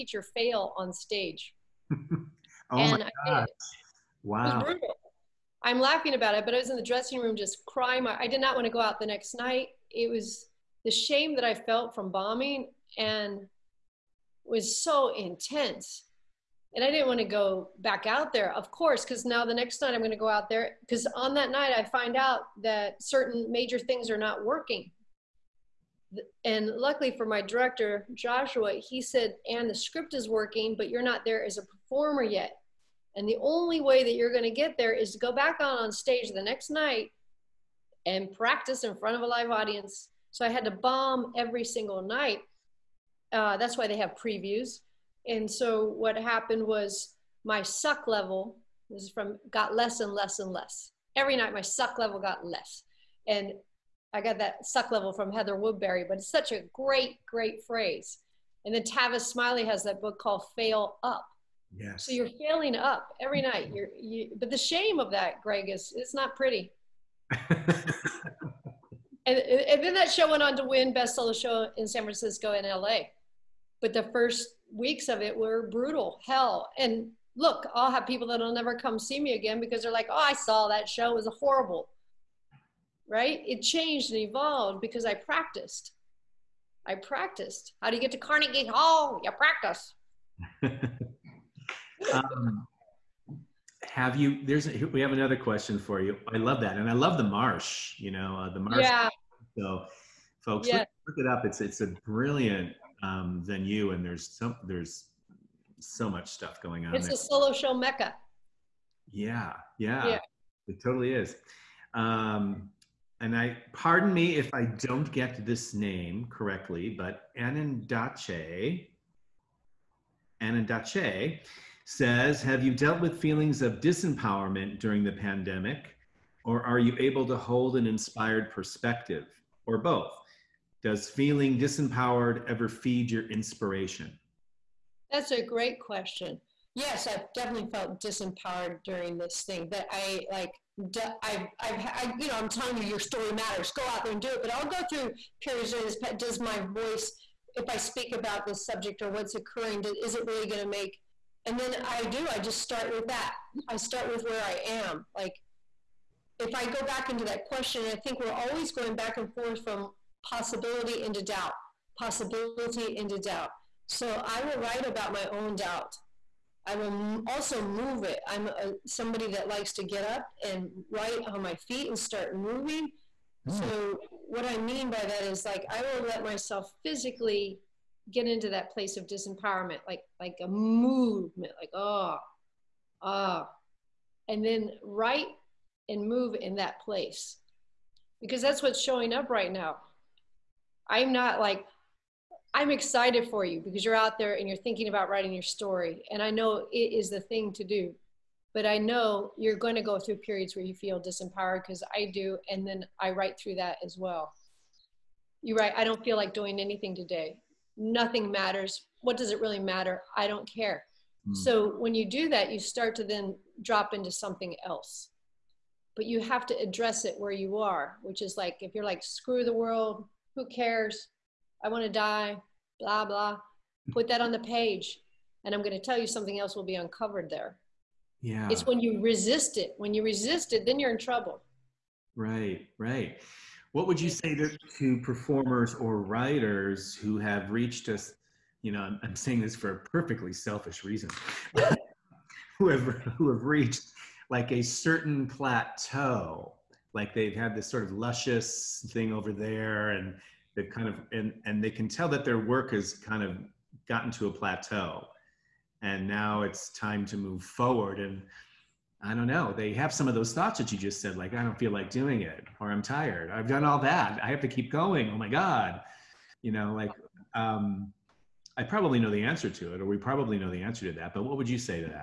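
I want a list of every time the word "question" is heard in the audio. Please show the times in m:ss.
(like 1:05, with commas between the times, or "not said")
1:35, 2:15, 2:37.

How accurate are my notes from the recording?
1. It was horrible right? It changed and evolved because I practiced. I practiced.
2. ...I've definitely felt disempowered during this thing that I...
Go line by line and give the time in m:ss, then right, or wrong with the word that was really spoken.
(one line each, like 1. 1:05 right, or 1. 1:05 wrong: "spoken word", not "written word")
1. 1:21 right
2. 2:17 right.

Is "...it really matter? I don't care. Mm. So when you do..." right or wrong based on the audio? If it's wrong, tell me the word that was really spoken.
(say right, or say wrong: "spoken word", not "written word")
right.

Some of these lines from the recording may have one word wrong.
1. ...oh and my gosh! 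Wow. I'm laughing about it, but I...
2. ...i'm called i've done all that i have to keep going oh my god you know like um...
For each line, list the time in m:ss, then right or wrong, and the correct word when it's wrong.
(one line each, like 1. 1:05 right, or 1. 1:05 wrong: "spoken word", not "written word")
1. 0:01 right
2. 4:22 wrong: "tired", not "called".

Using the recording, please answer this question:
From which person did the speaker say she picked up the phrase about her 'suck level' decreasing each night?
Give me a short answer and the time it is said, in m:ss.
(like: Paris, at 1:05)
Heather Woodbury, at 0:55.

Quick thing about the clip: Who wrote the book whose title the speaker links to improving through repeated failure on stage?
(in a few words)
Tavis Smiley.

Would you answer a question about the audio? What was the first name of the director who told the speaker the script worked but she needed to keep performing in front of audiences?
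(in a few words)
Joshua.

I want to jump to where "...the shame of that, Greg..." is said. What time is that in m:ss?
1:04.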